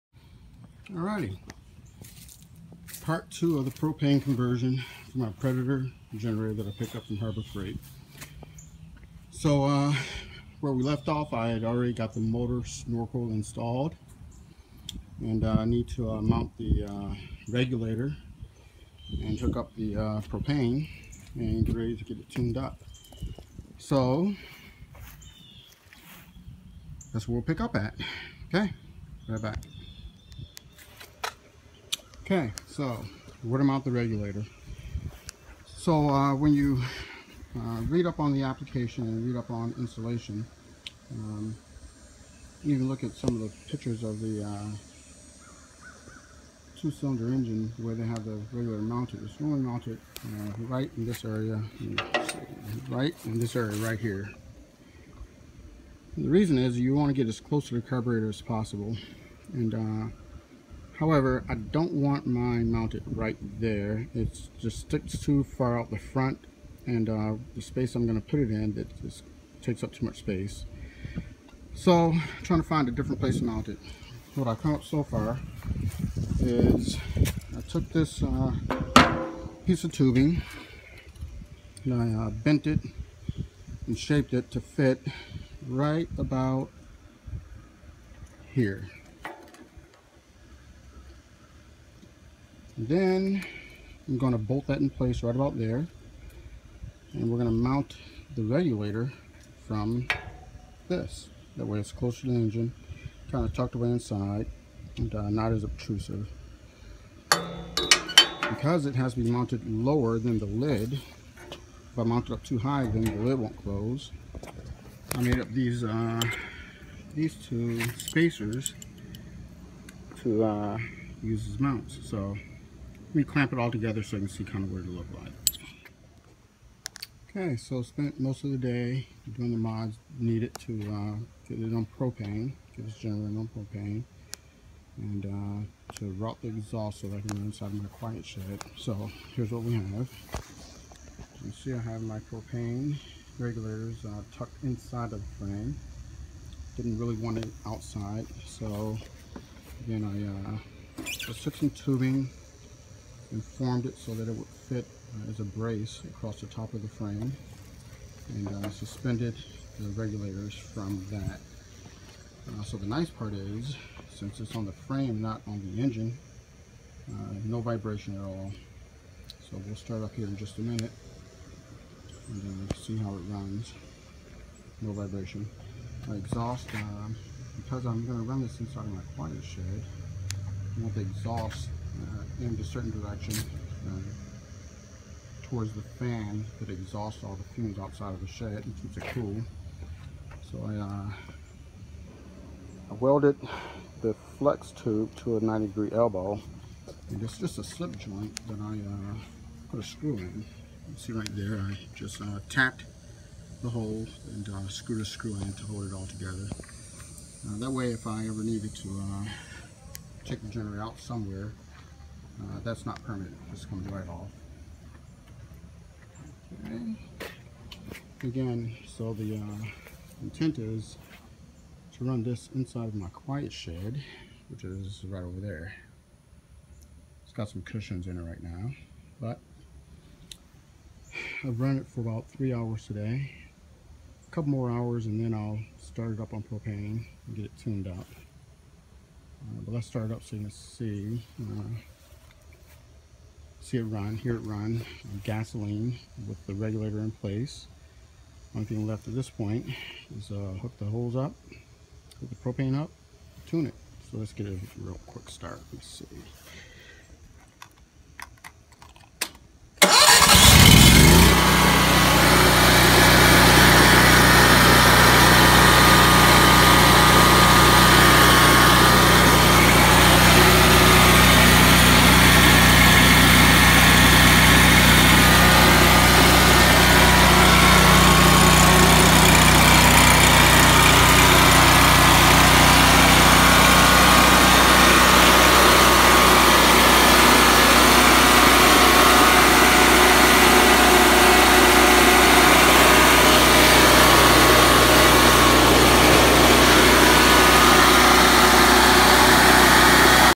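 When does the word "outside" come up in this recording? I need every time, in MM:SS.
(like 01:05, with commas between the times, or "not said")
02:27, 03:07.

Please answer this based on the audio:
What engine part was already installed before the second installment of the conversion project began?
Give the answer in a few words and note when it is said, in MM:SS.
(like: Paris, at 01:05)
motor snorkel, at 00:12.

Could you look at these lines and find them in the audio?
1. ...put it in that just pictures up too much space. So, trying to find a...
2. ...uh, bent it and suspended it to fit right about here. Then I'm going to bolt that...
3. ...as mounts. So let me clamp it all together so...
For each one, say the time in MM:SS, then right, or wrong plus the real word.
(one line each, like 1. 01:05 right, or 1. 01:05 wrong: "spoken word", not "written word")
1. 01:08 wrong: "takes", not "pictures"
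2. 01:22 wrong: "shaped", not "suspended"
3. 02:01 right.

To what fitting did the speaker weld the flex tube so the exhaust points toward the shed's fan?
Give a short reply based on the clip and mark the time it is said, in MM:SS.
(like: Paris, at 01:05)
90 degree elbow, at 03:15.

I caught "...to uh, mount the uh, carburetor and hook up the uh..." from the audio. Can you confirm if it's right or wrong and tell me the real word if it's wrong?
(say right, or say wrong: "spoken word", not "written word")
wrong: "regulator", not "carburetor".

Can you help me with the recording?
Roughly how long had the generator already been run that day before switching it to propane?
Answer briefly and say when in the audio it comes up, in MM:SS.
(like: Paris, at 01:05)
3 hours, at 03:52.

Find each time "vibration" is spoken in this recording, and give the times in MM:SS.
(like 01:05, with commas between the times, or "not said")
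02:47, 02:54.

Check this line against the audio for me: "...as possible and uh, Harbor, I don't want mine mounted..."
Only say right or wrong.
wrong.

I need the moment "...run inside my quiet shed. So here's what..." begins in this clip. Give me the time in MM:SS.
02:17.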